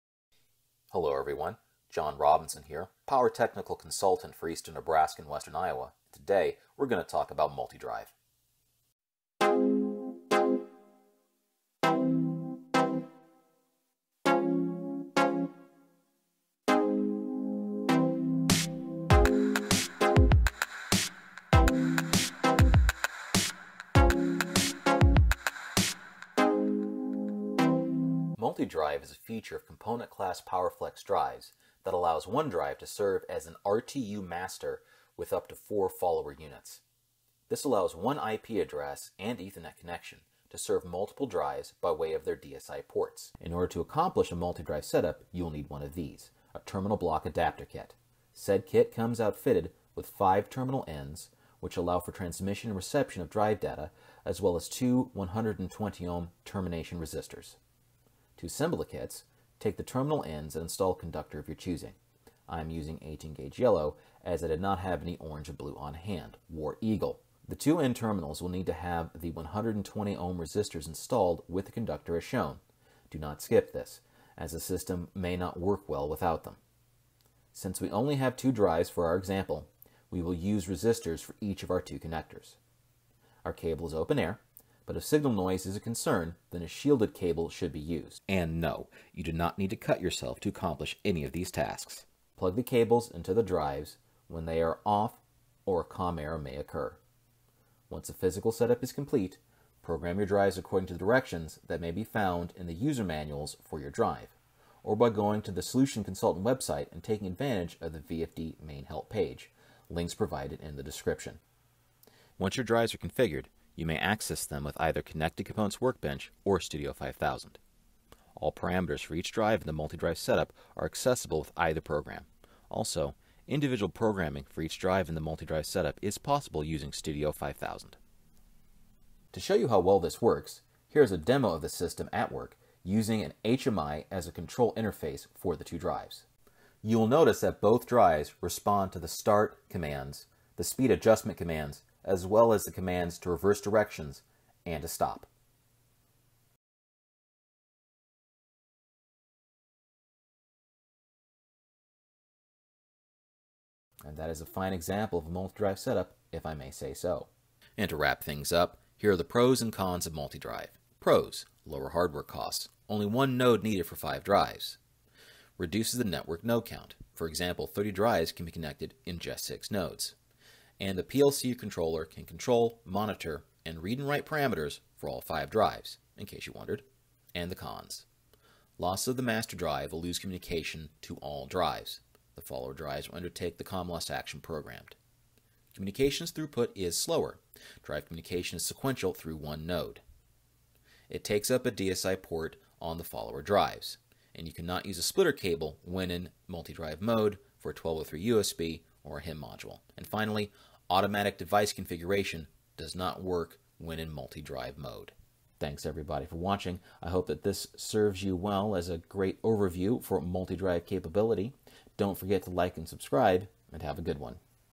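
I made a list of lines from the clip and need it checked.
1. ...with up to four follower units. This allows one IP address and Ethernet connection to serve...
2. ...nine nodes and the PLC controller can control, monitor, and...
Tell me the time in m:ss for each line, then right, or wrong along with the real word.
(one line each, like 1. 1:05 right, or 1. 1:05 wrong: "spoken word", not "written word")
1. 0:35 right
2. 2:49 wrong: "six", not "nine".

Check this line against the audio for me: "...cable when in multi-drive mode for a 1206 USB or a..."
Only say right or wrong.
wrong.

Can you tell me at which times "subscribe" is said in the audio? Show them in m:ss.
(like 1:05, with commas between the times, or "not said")
3:32.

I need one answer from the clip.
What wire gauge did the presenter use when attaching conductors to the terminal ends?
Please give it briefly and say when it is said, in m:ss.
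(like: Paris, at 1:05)
18 gauge, at 1:03.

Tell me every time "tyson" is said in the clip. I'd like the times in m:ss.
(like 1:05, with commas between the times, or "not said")
not said.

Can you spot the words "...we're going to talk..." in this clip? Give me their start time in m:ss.
0:06.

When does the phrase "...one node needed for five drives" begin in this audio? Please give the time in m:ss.
2:43.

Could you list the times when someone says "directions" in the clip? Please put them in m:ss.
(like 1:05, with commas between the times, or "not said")
1:40, 2:23.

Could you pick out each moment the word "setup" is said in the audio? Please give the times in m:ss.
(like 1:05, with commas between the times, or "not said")
0:44, 1:38, 2:00, 2:05, 2:35.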